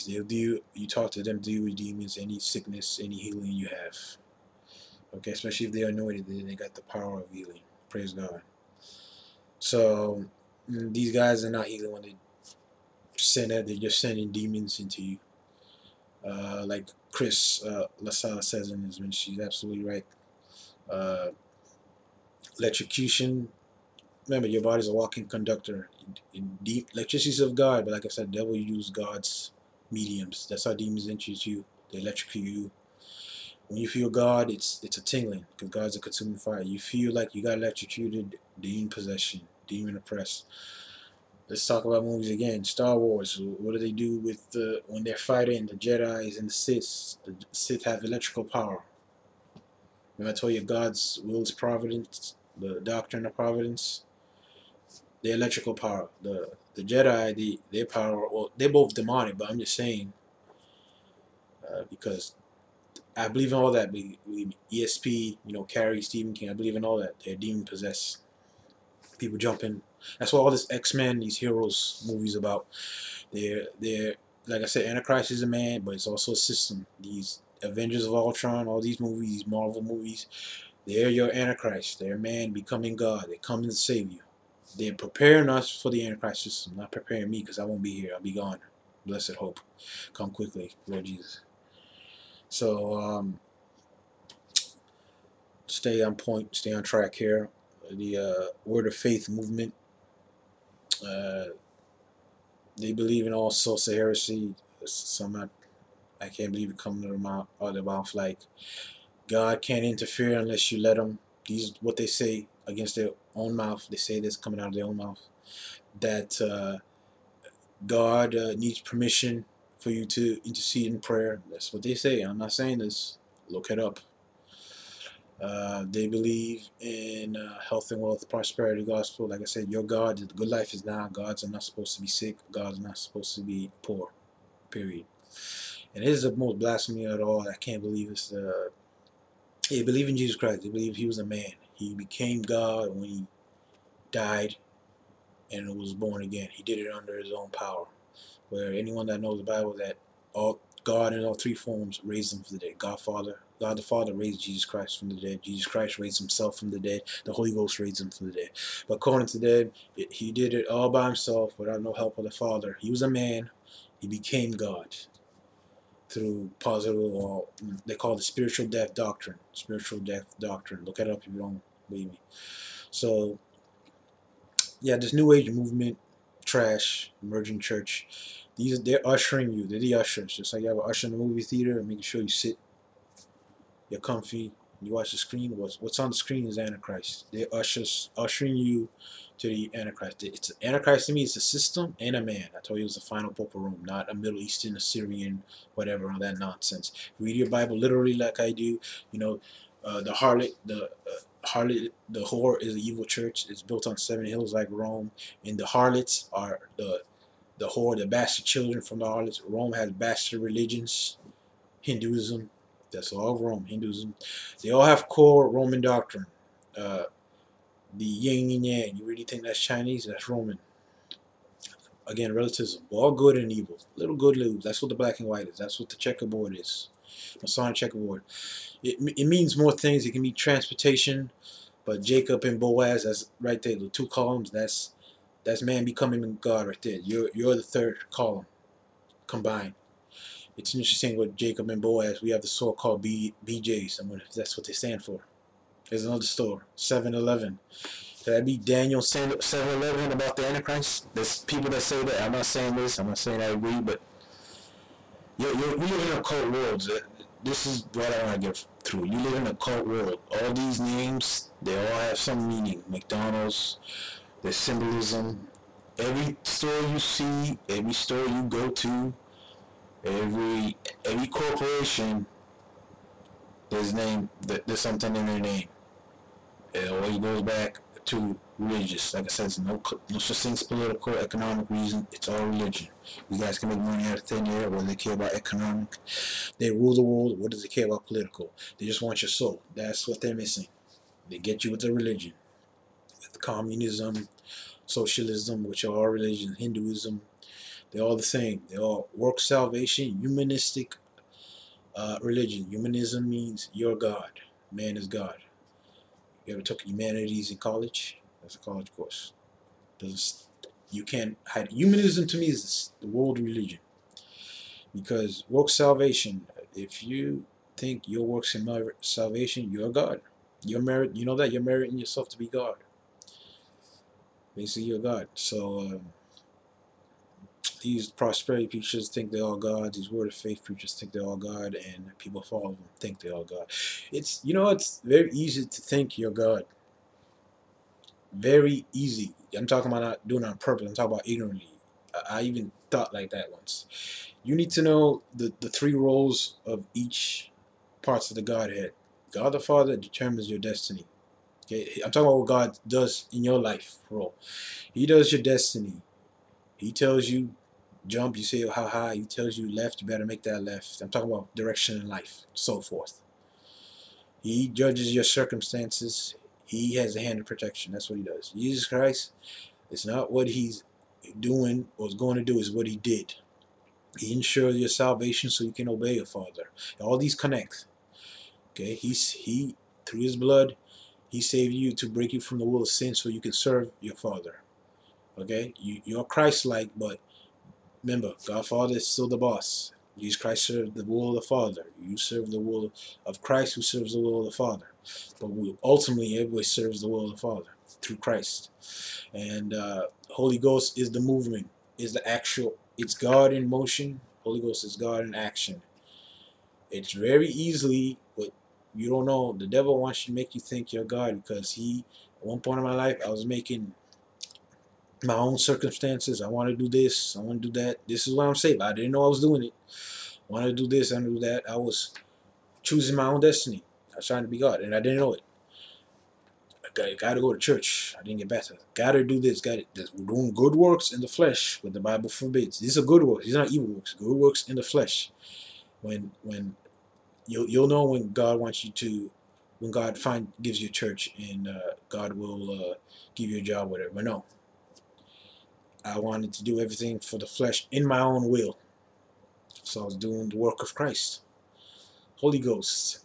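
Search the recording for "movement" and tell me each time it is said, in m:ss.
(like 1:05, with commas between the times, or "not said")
1:39, 2:55, 6:41.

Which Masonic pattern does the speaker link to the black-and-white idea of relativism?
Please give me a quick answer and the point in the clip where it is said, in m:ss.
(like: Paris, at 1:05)
Masonic Checkerboard, at 3:47.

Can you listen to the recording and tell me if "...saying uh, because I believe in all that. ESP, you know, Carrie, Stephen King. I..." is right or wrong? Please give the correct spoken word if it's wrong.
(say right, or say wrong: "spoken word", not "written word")
right.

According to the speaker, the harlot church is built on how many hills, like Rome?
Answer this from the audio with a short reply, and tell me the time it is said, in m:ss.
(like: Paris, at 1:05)
7, at 3:23.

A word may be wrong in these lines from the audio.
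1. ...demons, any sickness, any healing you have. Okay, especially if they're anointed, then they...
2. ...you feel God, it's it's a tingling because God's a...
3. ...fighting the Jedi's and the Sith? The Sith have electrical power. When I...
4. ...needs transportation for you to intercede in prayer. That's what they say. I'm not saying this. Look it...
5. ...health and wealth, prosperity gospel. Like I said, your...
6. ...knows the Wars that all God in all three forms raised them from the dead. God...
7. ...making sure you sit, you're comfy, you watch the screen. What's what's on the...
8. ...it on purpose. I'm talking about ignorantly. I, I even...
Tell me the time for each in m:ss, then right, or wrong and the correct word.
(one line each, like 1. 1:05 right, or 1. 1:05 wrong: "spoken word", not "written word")
1. 0:01 right
2. 0:33 right
3. 0:45 right
4. 1:58 wrong: "permission", not "transportation"
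5. 2:07 right
6. 2:29 wrong: "Bible", not "Wars"
7. 3:01 right
8. 5:40 right.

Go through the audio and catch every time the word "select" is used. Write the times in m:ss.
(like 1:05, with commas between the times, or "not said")
not said.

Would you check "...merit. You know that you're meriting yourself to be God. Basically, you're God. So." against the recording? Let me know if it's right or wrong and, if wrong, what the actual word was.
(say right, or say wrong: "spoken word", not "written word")
right.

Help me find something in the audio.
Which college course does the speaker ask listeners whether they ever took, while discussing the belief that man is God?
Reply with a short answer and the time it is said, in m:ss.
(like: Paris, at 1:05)
humanities, at 5:06.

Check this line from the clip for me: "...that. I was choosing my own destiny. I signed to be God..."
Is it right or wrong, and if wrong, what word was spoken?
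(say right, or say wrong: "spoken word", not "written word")
right.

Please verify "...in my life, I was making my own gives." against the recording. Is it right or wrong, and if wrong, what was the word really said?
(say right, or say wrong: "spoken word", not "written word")
wrong: "circumstances", not "gives".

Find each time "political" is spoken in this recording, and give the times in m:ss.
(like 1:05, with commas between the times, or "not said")
4:40, 4:48.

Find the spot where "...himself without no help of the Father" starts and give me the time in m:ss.
2:41.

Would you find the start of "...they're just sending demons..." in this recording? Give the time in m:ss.
0:13.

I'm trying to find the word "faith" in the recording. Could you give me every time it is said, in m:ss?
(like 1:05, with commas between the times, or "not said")
1:38, 5:30.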